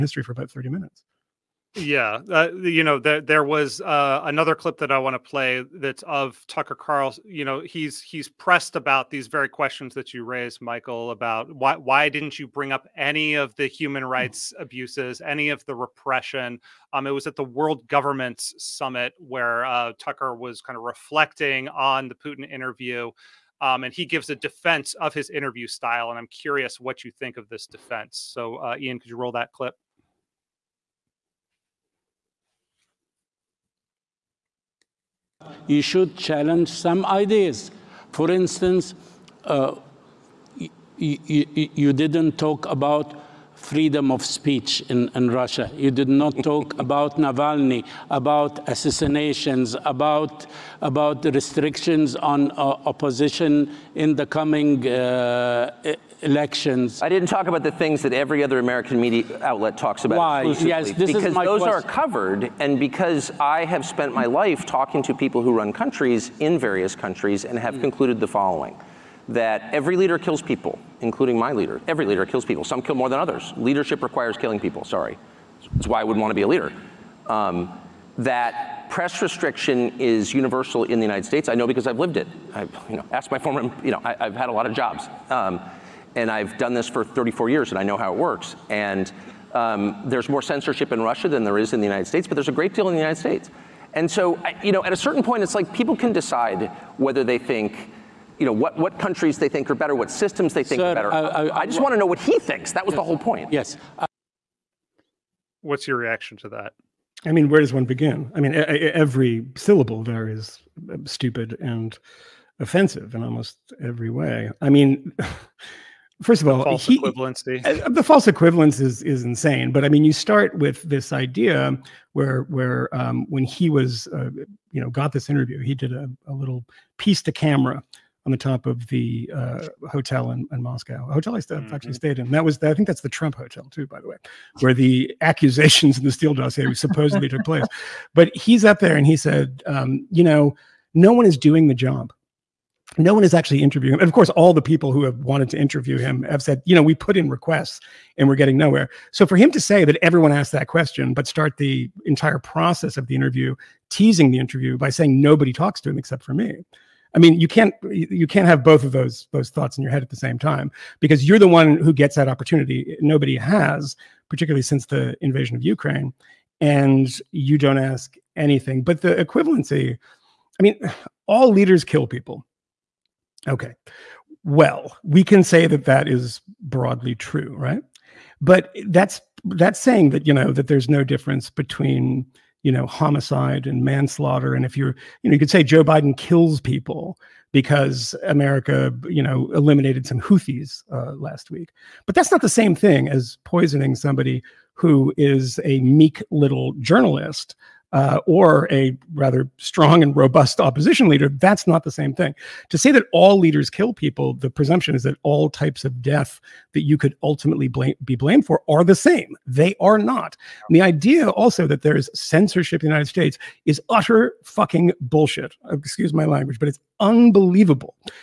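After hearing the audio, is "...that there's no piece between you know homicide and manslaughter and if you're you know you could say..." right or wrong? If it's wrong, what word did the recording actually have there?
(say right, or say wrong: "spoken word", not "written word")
wrong: "difference", not "piece".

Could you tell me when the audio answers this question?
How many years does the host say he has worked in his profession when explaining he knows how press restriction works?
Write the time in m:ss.
1:27.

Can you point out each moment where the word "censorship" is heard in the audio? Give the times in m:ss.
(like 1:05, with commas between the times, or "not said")
1:30, 3:32.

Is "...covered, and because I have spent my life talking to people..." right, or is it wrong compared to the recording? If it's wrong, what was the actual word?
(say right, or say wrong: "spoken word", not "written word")
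right.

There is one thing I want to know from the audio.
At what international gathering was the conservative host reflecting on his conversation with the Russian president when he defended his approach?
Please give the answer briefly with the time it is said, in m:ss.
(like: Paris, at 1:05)
World Governments Summit, at 0:17.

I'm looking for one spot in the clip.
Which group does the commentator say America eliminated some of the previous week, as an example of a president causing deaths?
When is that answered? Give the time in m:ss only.
3:10.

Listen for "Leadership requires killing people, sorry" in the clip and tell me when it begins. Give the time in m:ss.
1:13.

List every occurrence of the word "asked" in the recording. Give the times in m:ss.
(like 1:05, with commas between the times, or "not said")
1:23, 2:30.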